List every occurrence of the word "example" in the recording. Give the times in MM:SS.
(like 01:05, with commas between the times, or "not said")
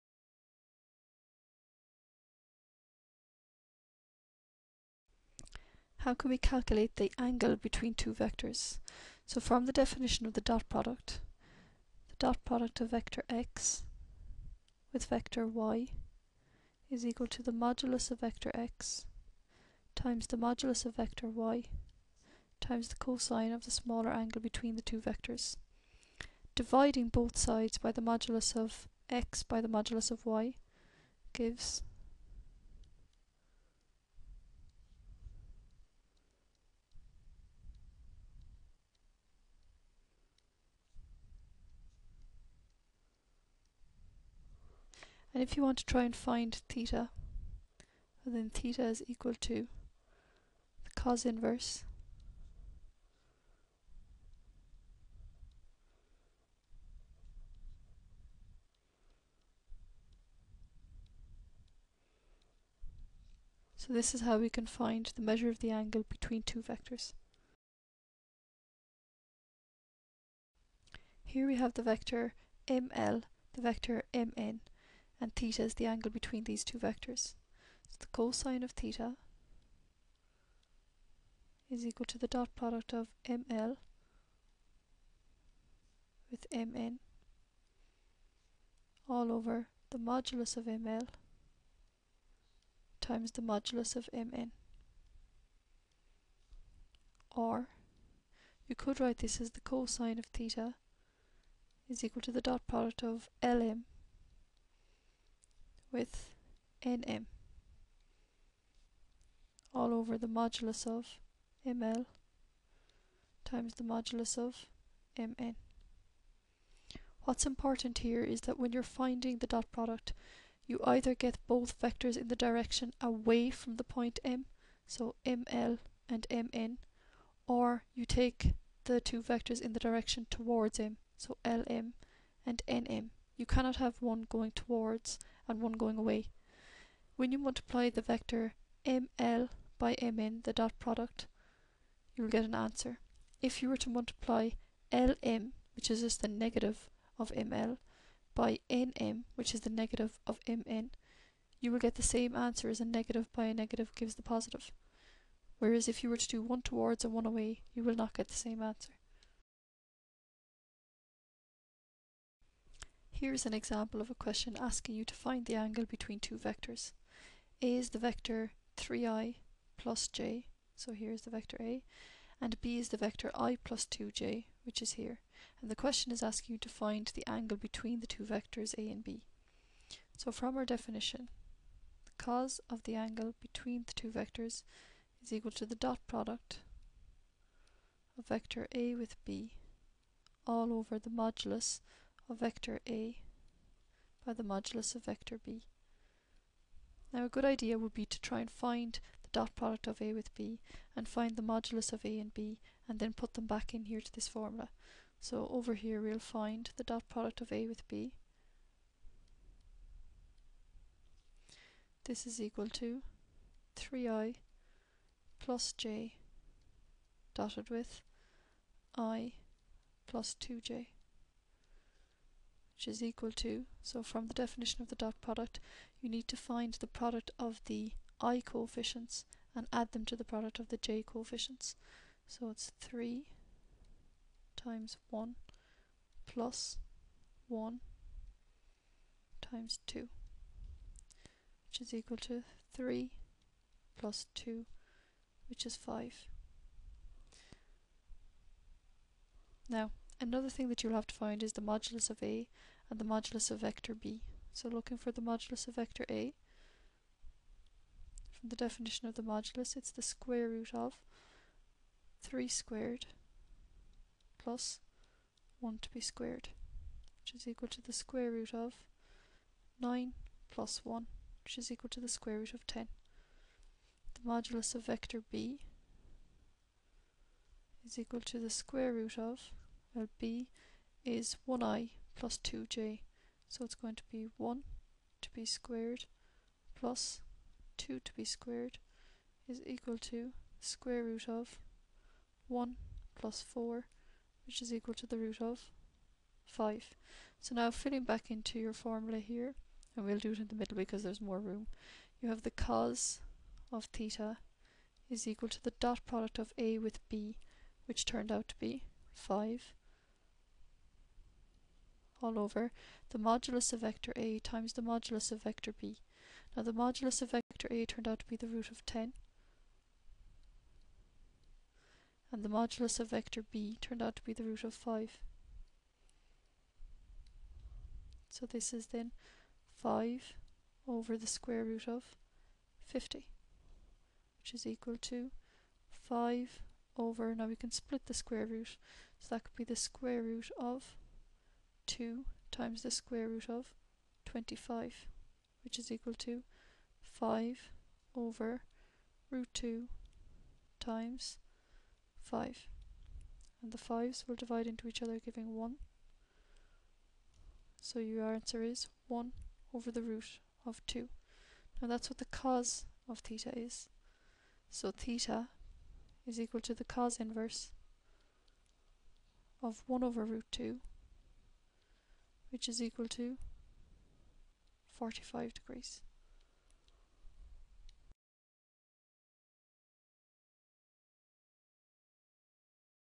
02:43.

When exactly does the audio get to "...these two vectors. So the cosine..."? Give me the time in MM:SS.
01:16.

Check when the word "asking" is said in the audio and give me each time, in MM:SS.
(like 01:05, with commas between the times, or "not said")
02:44, 02:56.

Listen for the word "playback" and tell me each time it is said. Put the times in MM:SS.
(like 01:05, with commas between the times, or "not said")
not said.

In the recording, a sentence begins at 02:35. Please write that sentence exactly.
Whereas if you were to do one towards and one away, you will not get the same answer.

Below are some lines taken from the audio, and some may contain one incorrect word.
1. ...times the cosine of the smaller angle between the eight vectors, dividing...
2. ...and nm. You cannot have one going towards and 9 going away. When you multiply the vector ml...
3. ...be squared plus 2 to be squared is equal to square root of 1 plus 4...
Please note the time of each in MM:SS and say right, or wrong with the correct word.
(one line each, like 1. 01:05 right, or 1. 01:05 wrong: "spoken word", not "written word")
1. 00:22 wrong: "two", not "eight"
2. 02:12 wrong: "1", not "9"
3. 04:45 right.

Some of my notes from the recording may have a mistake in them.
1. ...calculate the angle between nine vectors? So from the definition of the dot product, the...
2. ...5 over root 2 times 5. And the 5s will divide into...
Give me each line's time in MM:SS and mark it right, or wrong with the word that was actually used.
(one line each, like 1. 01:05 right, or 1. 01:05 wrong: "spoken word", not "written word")
1. 00:06 wrong: "two", not "nine"
2. 05:47 right.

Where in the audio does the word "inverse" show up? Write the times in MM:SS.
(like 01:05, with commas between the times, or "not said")
00:51, 06:07.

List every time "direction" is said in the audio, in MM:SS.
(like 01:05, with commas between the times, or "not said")
02:02, 02:09.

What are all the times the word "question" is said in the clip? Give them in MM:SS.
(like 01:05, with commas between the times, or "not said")
02:44, 02:55.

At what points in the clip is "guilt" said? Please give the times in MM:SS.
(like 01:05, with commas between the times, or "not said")
not said.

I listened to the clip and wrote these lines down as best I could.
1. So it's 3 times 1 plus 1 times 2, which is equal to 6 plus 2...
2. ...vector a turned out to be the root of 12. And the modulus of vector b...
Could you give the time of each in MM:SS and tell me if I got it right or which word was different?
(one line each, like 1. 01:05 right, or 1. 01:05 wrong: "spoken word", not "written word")
1. 03:52 wrong: "3", not "6"
2. 05:17 wrong: "10", not "12".